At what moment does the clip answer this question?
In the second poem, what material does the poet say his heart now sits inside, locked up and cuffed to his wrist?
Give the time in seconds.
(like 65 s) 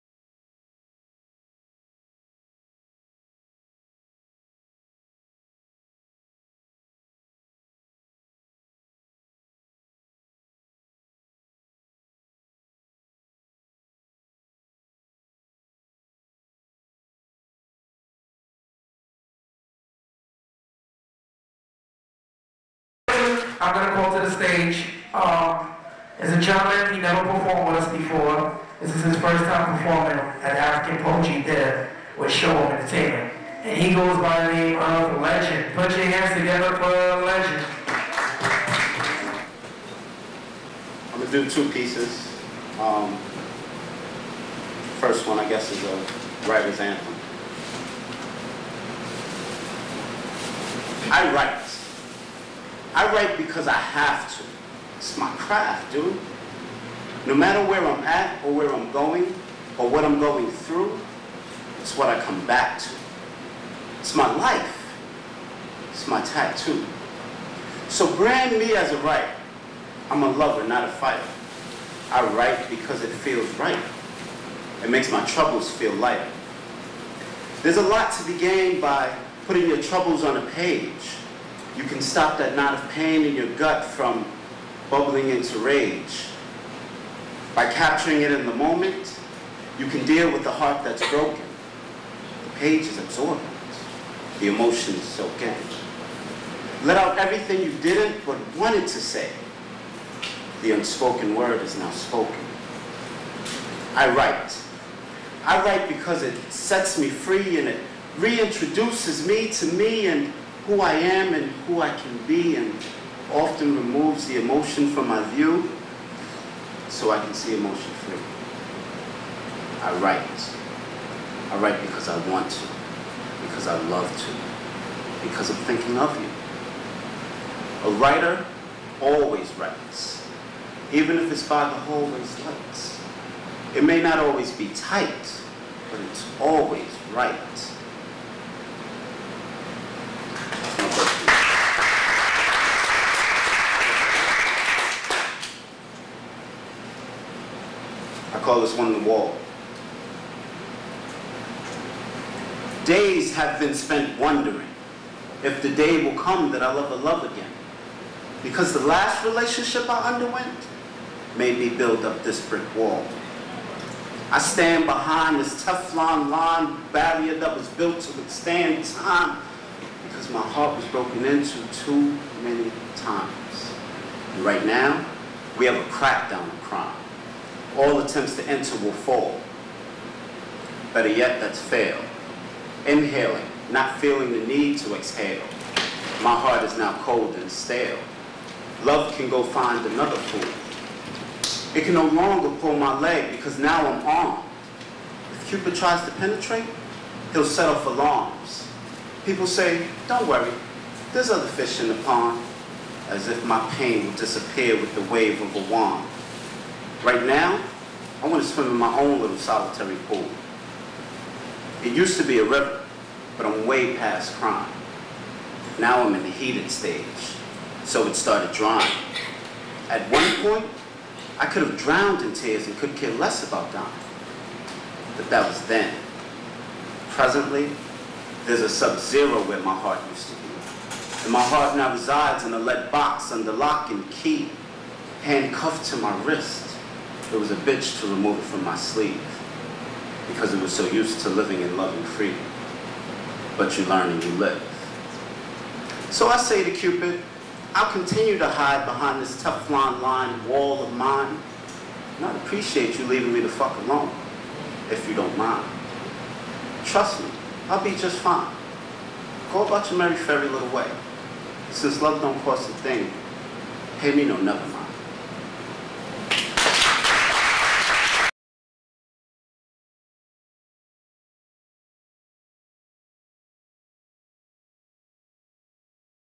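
232 s.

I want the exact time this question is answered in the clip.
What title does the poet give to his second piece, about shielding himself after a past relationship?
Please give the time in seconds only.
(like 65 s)
148 s.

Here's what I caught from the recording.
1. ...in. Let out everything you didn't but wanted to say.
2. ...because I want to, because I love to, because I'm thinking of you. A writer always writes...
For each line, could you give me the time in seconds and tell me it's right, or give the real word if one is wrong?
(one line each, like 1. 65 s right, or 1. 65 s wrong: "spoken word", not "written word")
1. 95 s right
2. 121 s right.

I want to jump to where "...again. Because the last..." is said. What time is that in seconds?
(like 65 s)
157 s.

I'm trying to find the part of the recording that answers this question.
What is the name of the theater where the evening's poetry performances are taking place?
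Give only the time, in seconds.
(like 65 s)
30 s.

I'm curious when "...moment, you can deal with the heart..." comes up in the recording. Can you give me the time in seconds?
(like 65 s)
88 s.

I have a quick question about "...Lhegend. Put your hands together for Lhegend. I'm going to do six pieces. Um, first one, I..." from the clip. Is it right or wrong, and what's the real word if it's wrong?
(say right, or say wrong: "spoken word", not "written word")
wrong: "two", not "six".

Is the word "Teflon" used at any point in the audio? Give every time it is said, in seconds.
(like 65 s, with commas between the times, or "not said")
165 s, 249 s.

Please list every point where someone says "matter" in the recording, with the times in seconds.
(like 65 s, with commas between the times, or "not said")
57 s.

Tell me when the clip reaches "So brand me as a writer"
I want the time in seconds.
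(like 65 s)
67 s.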